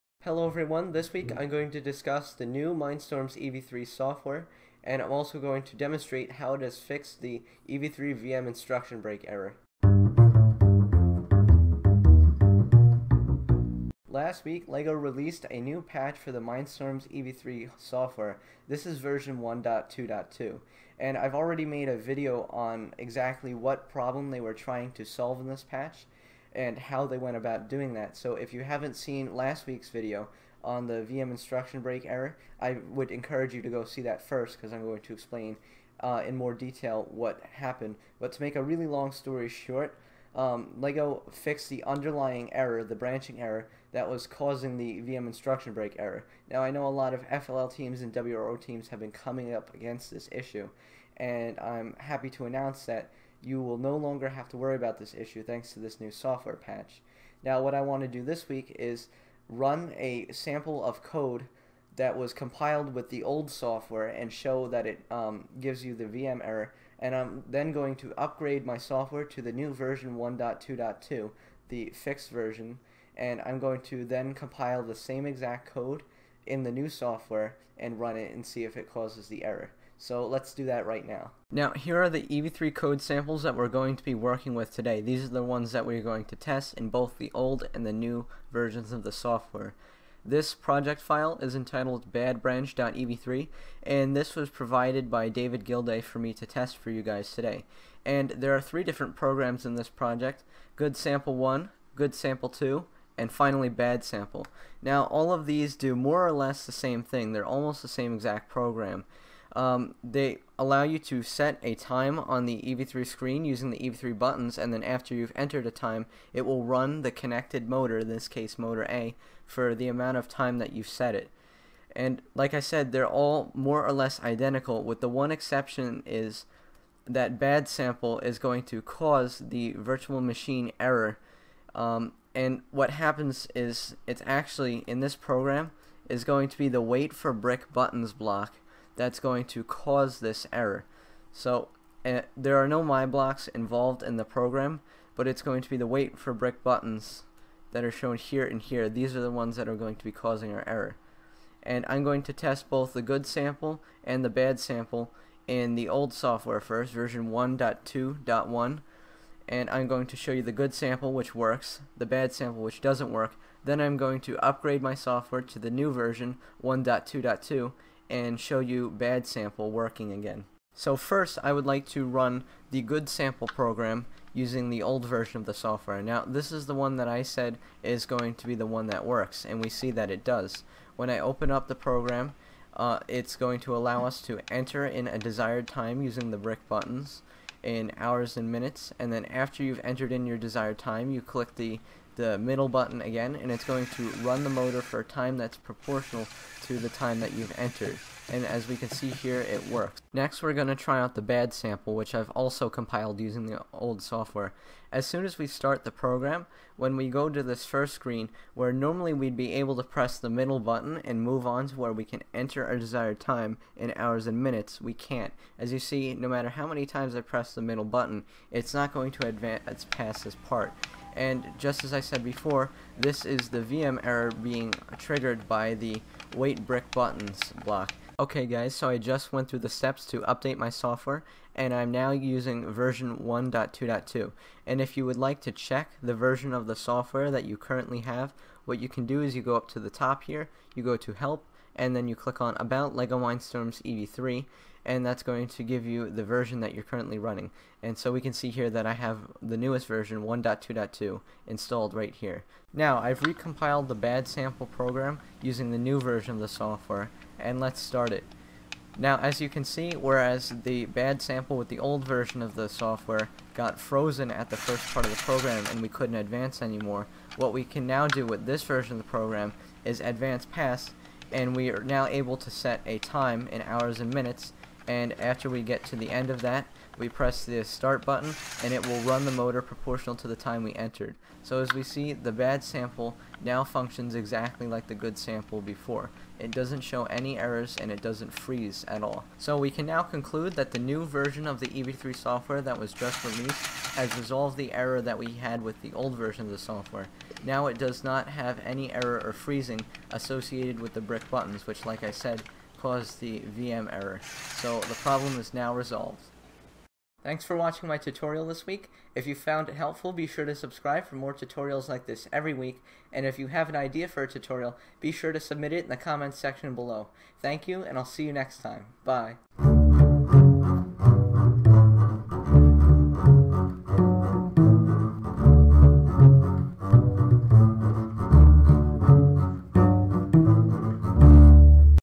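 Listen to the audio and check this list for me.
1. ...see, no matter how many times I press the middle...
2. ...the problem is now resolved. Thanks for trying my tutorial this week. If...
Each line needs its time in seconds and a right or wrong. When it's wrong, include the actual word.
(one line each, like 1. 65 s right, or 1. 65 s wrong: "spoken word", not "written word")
1. 215 s right
2. 304 s wrong: "watching", not "trying".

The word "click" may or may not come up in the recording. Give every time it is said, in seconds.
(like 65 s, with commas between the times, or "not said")
191 s, 242 s.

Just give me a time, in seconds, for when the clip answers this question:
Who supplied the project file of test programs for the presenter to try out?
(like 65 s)
95 s.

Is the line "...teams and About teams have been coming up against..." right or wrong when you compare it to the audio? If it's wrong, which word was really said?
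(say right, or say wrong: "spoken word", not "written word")
wrong: "WRO", not "About".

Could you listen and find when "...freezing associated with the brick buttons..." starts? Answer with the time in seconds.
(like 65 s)
299 s.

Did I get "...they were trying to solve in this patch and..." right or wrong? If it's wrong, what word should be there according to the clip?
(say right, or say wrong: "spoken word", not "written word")
right.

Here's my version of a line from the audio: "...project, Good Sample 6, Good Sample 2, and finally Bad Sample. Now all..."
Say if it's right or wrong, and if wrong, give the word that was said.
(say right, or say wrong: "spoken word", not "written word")
wrong: "1", not "6".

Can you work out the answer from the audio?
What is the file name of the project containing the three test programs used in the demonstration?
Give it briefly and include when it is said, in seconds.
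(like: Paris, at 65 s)
badbranch.ev3, at 92 s.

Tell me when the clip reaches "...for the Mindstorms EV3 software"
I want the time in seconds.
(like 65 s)
16 s.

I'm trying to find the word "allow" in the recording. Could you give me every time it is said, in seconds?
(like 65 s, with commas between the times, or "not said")
110 s, 183 s.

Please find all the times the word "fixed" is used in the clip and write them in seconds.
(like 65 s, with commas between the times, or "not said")
6 s, 41 s, 71 s.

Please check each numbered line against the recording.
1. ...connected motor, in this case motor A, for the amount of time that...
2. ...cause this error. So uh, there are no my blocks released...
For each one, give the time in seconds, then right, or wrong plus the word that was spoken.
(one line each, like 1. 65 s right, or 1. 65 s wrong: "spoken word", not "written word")
1. 117 s right
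2. 139 s wrong: "involved", not "released".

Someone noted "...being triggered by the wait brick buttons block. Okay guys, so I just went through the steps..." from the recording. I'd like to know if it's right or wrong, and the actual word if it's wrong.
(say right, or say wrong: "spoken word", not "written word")
right.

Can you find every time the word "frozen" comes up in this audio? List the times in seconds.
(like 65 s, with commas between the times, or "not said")
263 s.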